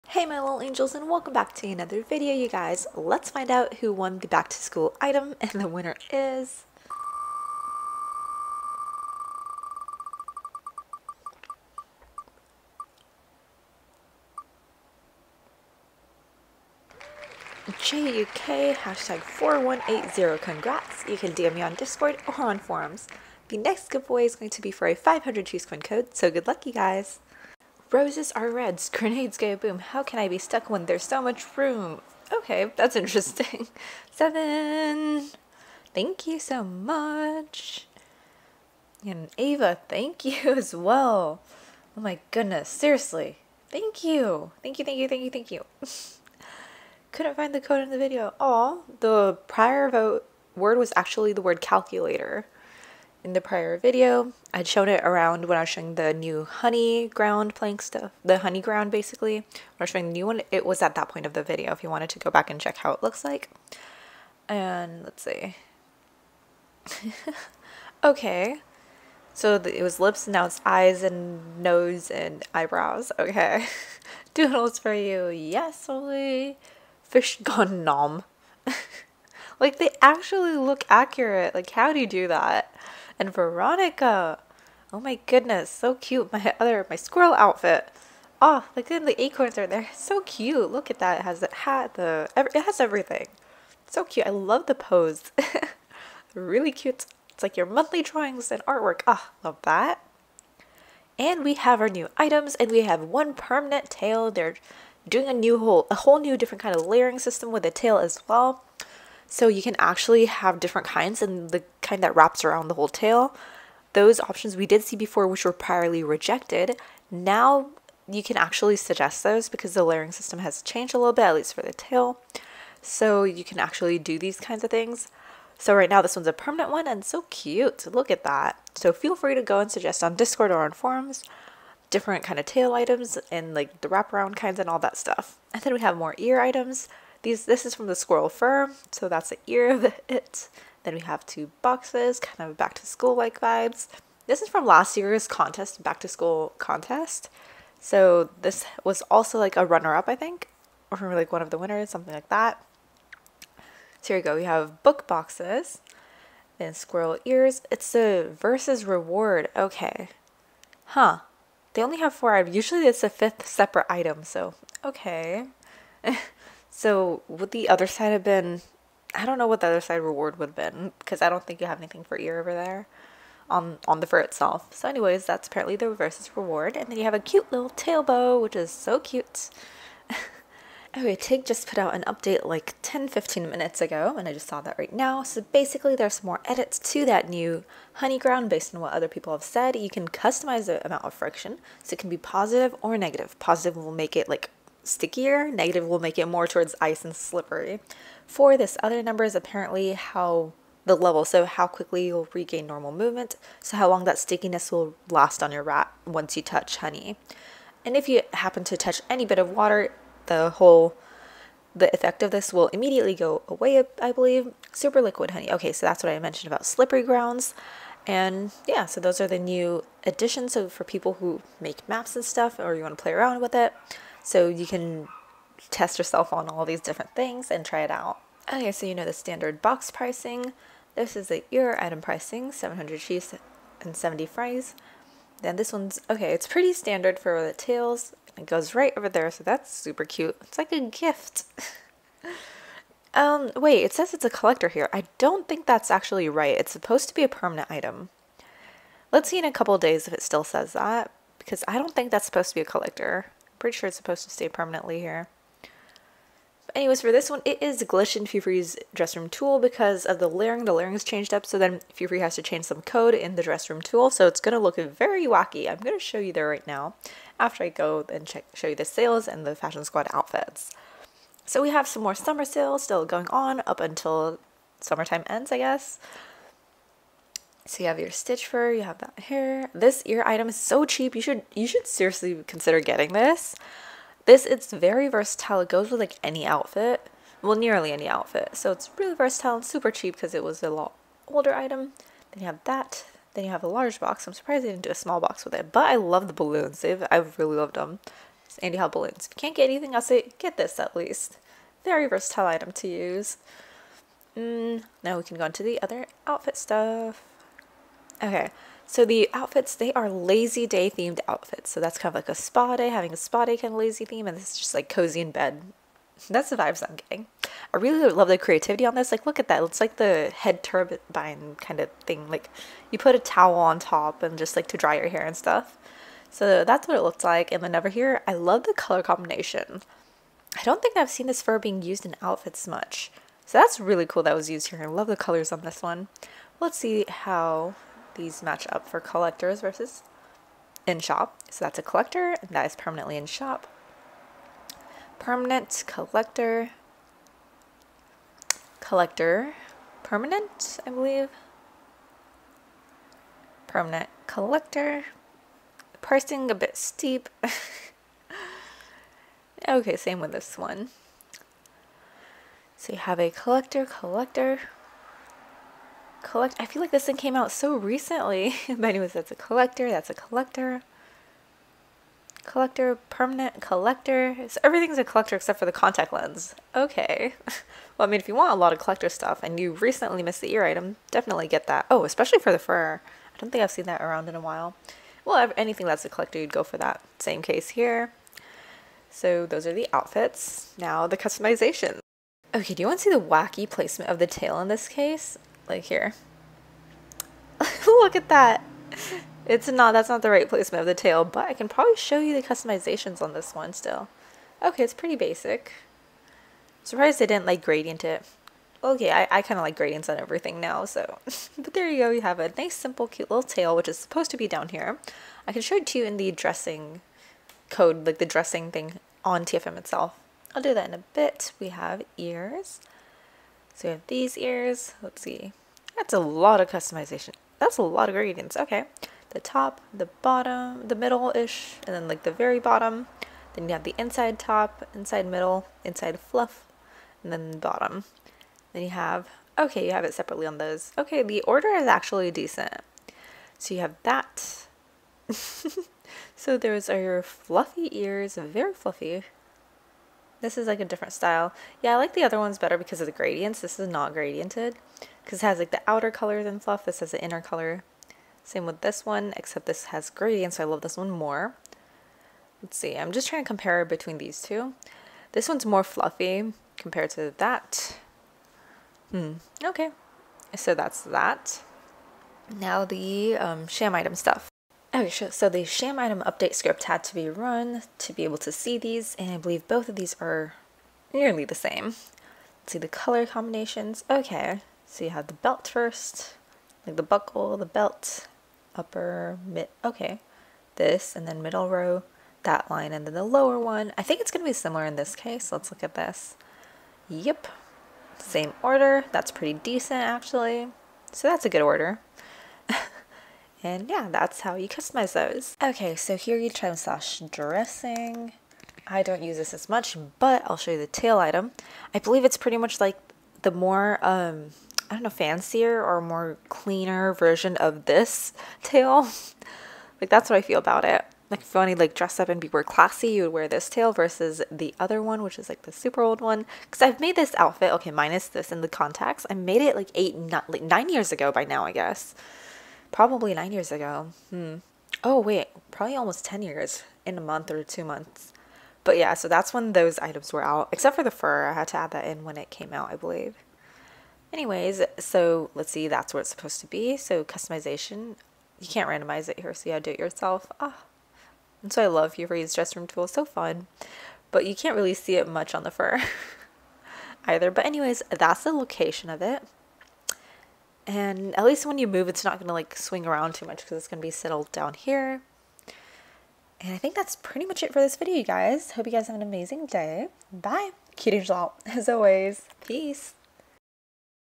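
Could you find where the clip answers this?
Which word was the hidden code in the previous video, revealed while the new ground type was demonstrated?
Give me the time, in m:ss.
0:51.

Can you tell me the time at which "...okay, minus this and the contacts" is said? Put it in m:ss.
8:47.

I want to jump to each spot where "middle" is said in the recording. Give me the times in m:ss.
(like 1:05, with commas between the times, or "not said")
7:10, 7:15, 8:11.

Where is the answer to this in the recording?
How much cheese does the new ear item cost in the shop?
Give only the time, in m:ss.
3:52.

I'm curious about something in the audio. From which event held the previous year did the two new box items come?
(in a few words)
back to school contest.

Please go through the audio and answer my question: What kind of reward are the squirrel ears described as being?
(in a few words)
versus reward.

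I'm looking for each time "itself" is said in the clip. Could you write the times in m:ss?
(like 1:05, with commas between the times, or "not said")
2:54, 6:59.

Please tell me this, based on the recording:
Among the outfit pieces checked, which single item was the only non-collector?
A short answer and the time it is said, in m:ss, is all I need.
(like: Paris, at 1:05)
contact lens, at 6:15.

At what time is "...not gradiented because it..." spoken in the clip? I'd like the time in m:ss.
7:33.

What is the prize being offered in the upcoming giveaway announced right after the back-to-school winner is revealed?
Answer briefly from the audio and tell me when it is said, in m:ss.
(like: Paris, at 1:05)
500 cheese coin code, at 0:24.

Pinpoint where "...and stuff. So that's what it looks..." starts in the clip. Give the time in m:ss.
5:25.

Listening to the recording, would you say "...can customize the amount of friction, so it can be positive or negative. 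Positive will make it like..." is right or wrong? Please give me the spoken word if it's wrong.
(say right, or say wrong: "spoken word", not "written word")
right.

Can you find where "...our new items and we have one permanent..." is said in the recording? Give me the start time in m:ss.
1:41.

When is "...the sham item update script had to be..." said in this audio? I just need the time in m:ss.
7:55.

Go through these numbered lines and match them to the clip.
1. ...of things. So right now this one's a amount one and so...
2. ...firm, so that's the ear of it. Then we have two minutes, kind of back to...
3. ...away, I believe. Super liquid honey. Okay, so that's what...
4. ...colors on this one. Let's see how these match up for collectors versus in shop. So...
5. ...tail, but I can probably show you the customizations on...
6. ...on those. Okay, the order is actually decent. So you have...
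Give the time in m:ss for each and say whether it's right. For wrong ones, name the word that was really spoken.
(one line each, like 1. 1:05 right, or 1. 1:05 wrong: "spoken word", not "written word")
1. 2:04 wrong: "permanent", not "amount"
2. 2:18 wrong: "boxes", not "minutes"
3. 3:33 right
4. 5:35 right
5. 6:40 right
6. 7:20 right.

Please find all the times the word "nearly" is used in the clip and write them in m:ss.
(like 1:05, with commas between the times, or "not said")
4:47, 8:01.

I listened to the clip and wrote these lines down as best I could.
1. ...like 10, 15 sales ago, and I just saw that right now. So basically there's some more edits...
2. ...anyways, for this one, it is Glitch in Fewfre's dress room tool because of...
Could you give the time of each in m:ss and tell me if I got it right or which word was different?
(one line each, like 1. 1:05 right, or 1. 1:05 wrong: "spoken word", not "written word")
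1. 3:02 wrong: "minutes", not "sales"
2. 4:16 right.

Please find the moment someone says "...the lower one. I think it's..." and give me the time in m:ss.
8:13.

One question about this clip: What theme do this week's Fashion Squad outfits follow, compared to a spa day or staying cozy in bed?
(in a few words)
lazy day.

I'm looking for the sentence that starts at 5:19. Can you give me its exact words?
It's like the head turbine kind of thing.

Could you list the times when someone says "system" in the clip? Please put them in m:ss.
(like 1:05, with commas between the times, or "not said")
1:47, 2:00.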